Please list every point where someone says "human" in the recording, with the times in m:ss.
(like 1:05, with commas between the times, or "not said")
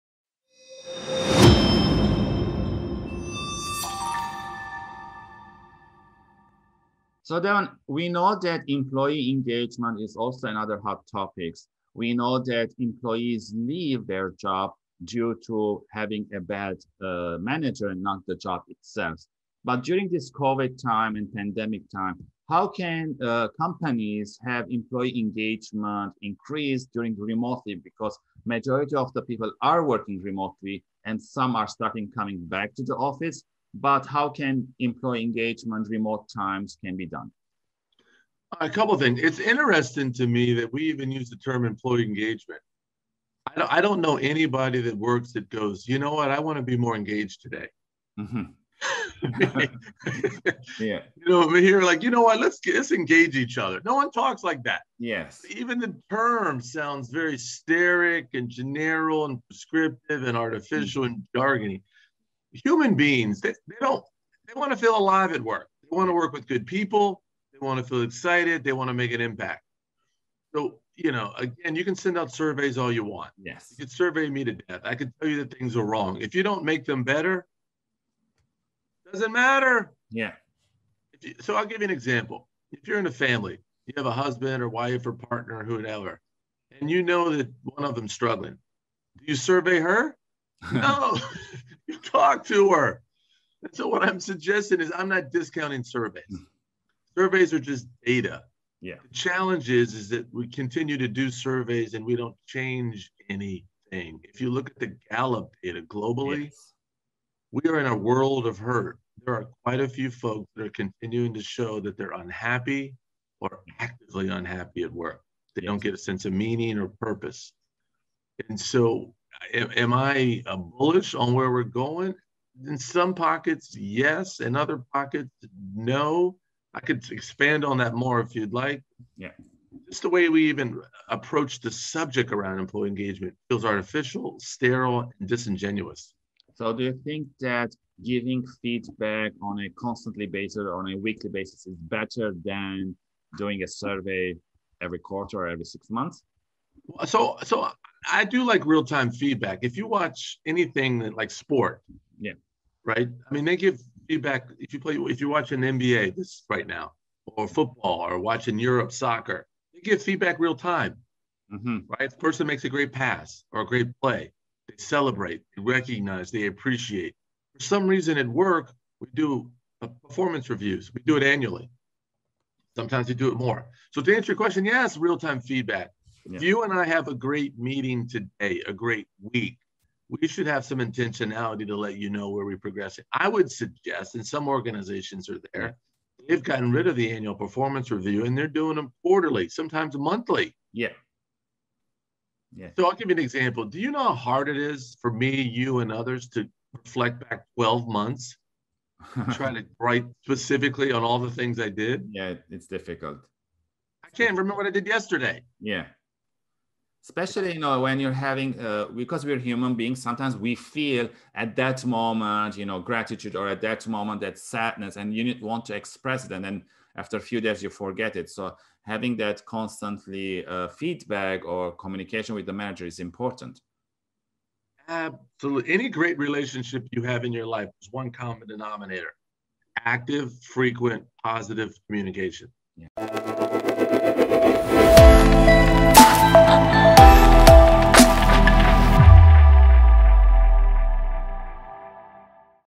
1:02, 3:29.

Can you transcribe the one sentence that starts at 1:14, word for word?
I could tell you that things are wrong.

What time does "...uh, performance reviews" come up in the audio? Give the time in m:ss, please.
2:49.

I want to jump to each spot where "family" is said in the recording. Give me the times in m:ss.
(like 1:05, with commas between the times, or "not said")
1:23.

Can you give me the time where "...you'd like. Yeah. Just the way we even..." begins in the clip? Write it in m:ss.
2:08.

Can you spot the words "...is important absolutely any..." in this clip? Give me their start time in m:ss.
3:42.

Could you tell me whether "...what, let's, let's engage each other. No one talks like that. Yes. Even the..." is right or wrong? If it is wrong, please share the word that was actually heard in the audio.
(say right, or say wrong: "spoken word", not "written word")
right.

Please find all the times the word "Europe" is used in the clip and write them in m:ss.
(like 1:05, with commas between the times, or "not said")
2:38.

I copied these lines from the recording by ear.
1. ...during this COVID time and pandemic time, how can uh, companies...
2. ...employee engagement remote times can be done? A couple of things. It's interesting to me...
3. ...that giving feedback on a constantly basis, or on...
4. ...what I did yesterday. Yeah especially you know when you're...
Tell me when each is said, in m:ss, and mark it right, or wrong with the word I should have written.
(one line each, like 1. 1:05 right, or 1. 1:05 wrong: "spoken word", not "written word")
1. 0:19 right
2. 0:34 right
3. 2:17 right
4. 3:24 right.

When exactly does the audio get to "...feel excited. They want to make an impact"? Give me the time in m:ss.
1:07.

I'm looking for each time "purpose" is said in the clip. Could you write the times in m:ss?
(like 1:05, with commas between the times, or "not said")
1:56.